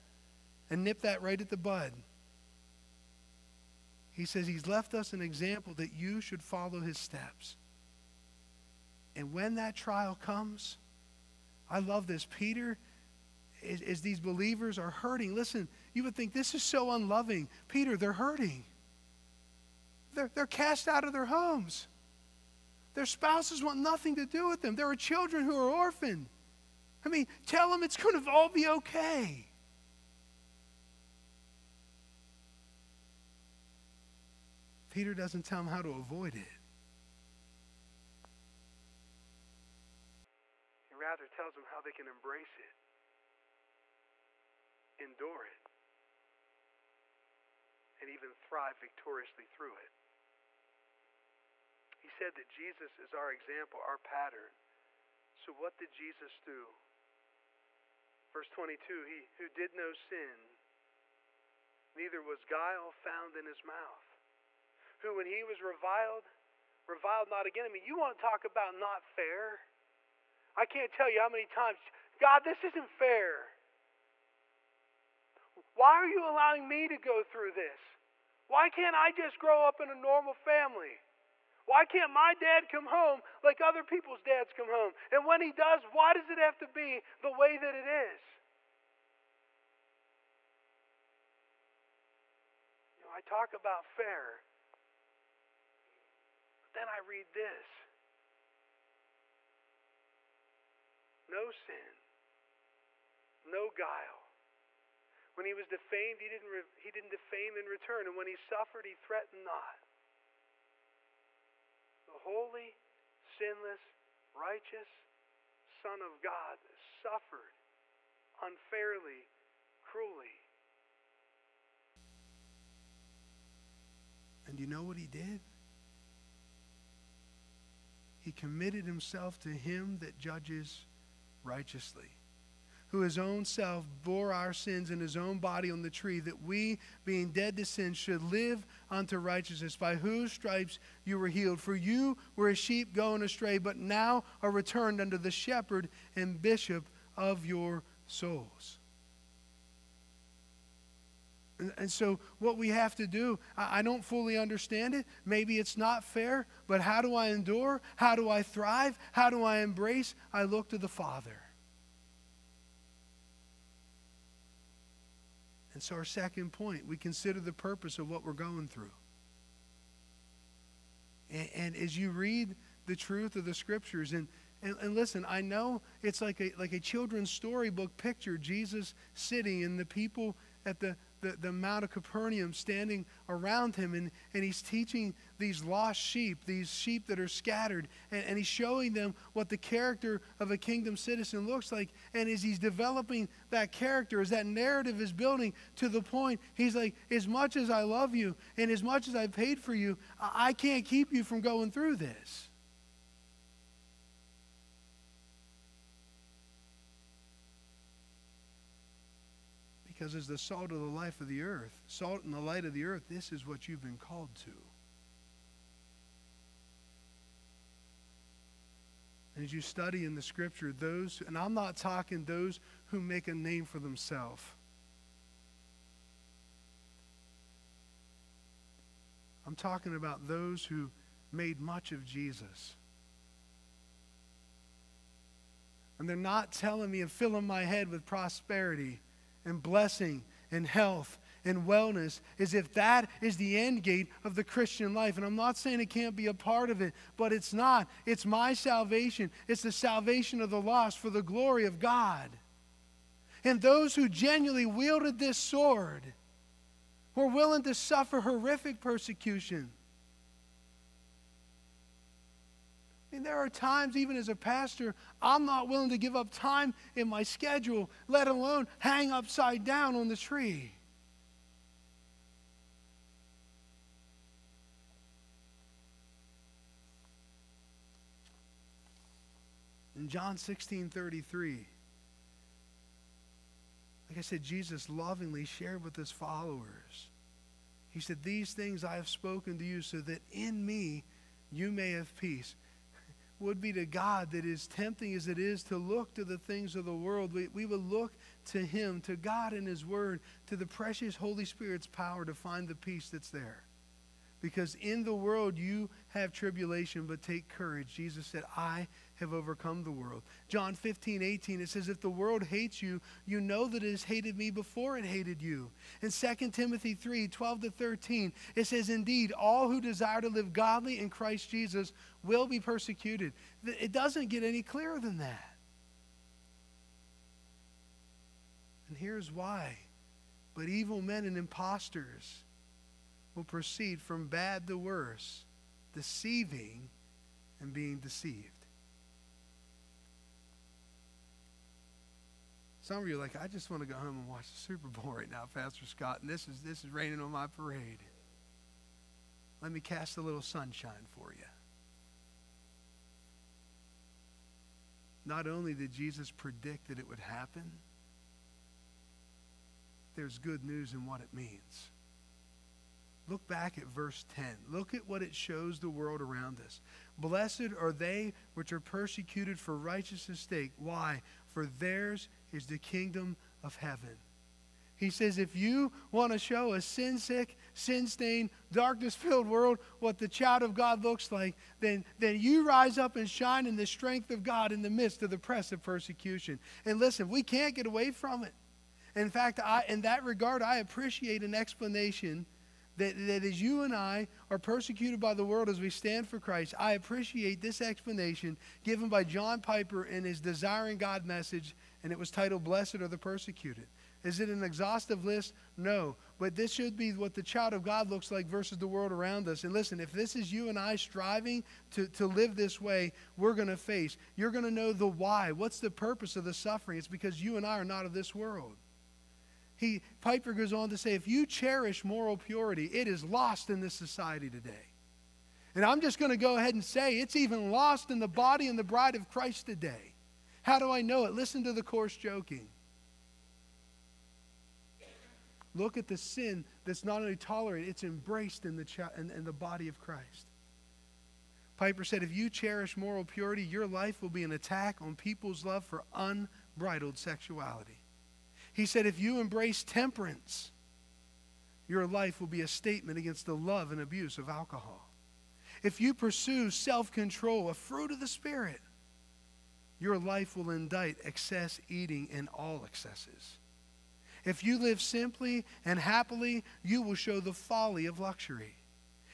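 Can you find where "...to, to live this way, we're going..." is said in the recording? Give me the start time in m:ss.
6:51.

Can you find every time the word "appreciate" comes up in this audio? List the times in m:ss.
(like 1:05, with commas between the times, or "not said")
6:30, 6:36.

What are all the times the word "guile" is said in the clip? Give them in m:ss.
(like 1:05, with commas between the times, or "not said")
1:02, 1:43.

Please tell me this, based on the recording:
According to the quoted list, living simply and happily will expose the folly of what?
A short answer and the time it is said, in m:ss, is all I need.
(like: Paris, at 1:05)
Luxury, at 7:48.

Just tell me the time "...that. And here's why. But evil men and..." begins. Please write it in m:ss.
5:25.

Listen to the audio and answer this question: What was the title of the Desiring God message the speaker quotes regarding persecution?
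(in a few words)
Blessed Are the Persecuted.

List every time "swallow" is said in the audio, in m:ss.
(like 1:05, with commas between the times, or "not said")
not said.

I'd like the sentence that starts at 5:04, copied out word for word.
Because in the world you have tribulation, but take courage.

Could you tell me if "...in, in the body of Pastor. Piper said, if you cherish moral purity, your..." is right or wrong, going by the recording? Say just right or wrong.
wrong.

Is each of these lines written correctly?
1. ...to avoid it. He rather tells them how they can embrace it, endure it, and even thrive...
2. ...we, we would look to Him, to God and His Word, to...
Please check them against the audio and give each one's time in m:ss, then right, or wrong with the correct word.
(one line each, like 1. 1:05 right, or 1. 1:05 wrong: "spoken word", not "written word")
1. 0:35 right
2. 4:57 right.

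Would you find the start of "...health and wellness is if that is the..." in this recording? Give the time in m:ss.
4:00.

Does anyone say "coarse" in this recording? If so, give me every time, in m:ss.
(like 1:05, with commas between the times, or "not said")
7:11.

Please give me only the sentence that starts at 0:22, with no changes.
Their spouses want nothing to do with them.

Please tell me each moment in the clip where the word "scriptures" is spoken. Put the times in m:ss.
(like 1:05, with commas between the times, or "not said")
2:53, 3:40.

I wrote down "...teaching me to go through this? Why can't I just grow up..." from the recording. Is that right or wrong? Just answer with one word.
wrong.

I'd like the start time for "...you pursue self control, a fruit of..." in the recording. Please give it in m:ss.
7:35.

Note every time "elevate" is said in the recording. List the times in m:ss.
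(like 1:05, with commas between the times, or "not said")
not said.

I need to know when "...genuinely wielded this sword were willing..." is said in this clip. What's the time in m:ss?
4:14.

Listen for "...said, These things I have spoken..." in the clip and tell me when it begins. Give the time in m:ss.
4:47.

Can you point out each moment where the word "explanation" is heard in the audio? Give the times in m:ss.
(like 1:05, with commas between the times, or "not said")
6:31, 6:37.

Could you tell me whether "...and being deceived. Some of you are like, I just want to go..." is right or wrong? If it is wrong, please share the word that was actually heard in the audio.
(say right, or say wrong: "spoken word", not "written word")
right.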